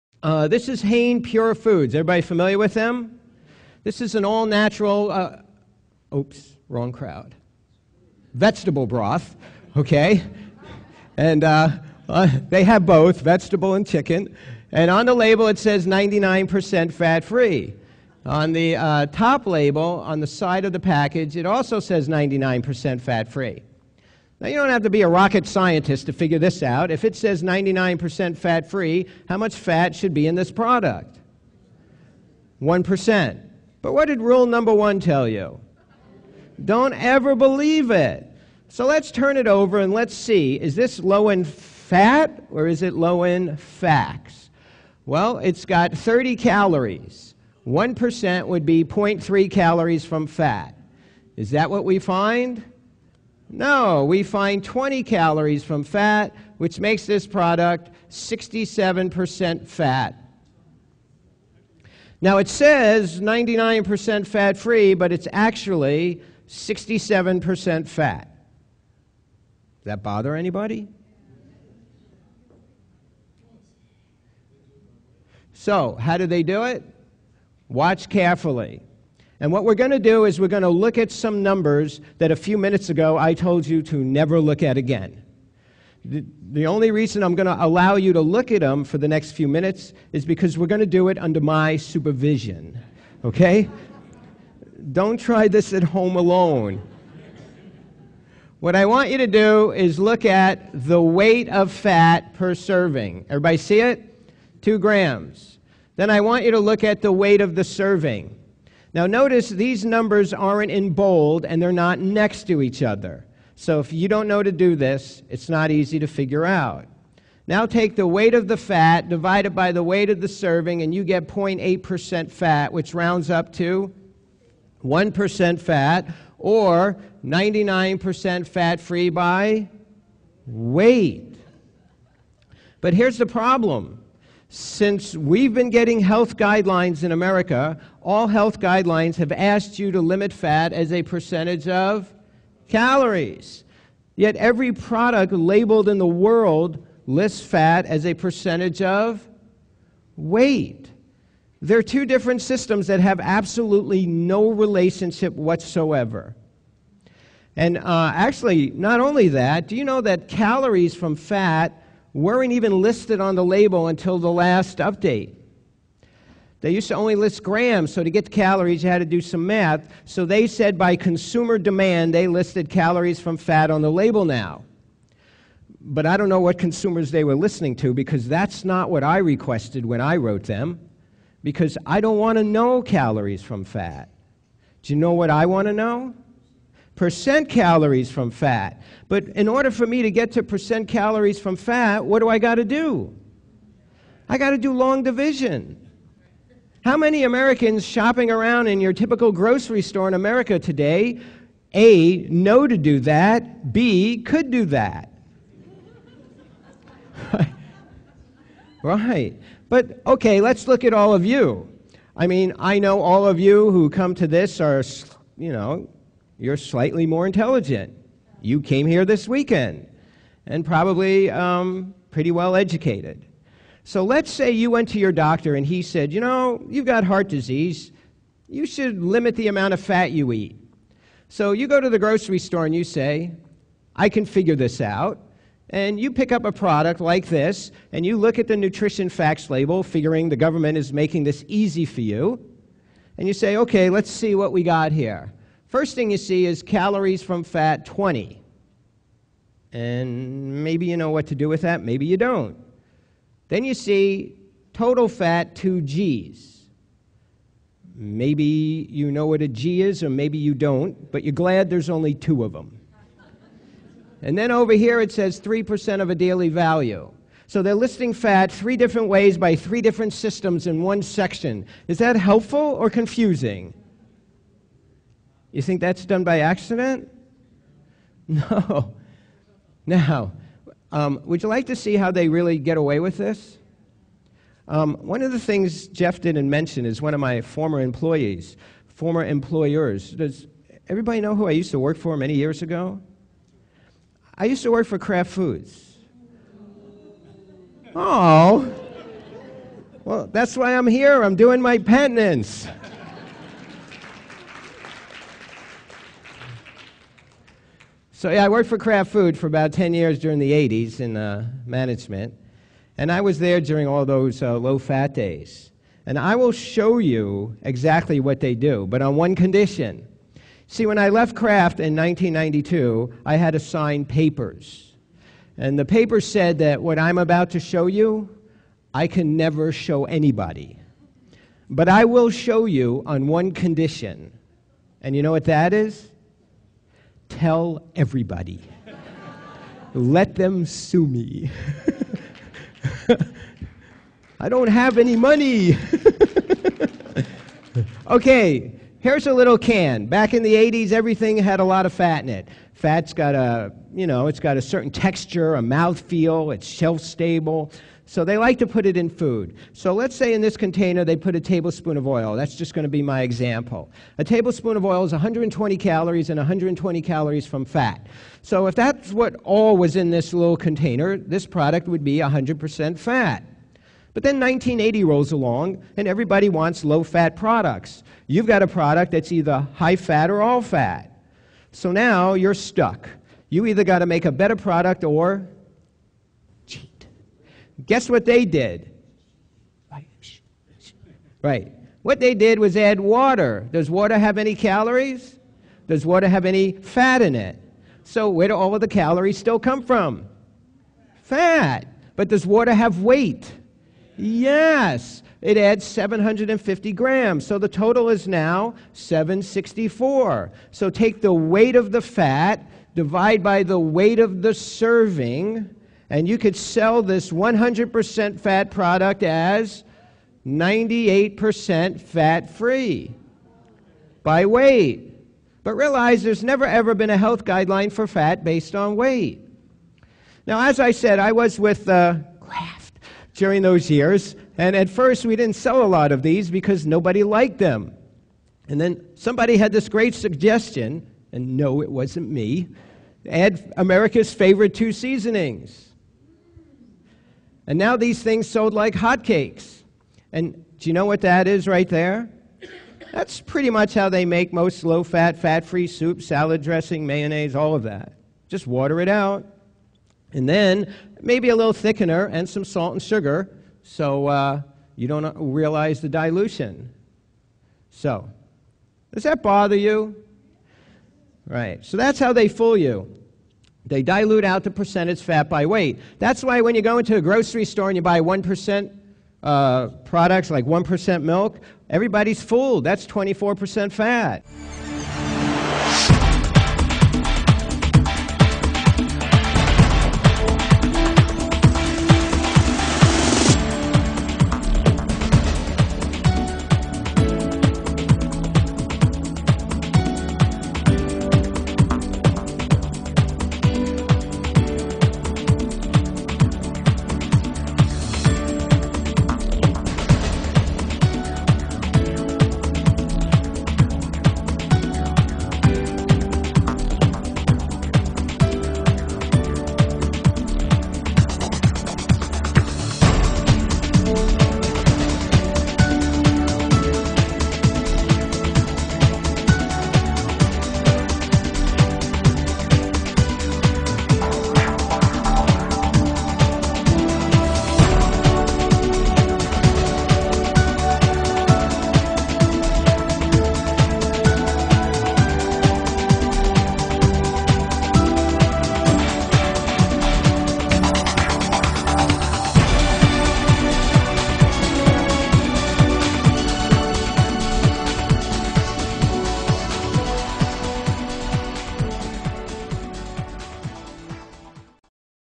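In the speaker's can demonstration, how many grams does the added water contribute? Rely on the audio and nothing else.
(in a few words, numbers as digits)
750 grams.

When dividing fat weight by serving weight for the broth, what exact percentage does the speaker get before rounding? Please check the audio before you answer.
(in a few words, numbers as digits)
0.8%.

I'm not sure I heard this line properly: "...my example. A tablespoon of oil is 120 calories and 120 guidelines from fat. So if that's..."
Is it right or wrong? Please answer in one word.
wrong.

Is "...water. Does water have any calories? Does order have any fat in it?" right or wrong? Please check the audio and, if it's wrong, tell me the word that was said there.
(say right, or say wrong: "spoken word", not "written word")
wrong: "water", not "order".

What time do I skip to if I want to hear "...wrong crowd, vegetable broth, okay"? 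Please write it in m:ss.
0:06.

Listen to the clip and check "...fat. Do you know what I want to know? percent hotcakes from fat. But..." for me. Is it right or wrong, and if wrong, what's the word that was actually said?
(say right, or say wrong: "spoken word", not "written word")
wrong: "calories", not "hotcakes".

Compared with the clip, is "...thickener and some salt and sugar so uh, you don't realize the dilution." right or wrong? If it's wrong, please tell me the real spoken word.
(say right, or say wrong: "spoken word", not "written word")
right.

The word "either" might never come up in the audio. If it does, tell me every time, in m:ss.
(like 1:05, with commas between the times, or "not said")
6:19, 6:23.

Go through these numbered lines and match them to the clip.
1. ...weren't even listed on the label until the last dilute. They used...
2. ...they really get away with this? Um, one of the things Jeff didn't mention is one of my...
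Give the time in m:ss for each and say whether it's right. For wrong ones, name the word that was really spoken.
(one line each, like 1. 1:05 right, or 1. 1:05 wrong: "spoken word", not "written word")
1. 2:42 wrong: "update", not "dilute"
2. 4:42 right.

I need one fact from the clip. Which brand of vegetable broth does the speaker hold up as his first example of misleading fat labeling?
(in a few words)
Hain Pure Foods.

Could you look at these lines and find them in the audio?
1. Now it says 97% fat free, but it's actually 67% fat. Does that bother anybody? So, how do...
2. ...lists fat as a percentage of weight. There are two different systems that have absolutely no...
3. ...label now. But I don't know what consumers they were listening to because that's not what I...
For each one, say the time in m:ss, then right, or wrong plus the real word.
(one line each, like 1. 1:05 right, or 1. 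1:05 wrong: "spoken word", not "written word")
1. 1:02 wrong: "99", not "97"
2. 2:27 right
3. 2:53 right.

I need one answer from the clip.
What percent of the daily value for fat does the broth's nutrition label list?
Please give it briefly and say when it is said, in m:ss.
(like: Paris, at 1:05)
3%, at 4:25.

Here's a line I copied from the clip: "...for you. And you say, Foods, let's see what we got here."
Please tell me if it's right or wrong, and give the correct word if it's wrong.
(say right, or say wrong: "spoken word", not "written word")
wrong: "Okay", not "Foods".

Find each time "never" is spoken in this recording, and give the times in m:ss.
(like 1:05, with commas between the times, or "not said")
1:23, 5:29, 7:06.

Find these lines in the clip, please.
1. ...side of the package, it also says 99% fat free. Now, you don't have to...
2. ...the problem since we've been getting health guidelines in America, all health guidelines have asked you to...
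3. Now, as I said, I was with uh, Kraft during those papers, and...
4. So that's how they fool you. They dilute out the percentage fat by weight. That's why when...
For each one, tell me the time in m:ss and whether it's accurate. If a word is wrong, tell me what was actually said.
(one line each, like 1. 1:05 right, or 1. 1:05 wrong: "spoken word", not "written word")
1. 0:20 right
2. 2:13 right
3. 7:10 wrong: "years", not "papers"
4. 7:51 right.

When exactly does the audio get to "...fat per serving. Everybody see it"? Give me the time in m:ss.
1:41.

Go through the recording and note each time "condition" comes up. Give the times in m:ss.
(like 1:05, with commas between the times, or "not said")
5:19, 5:33.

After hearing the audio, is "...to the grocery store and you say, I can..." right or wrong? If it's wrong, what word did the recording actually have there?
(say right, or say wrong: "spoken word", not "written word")
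right.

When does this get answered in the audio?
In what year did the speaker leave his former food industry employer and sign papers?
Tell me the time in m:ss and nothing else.
5:21.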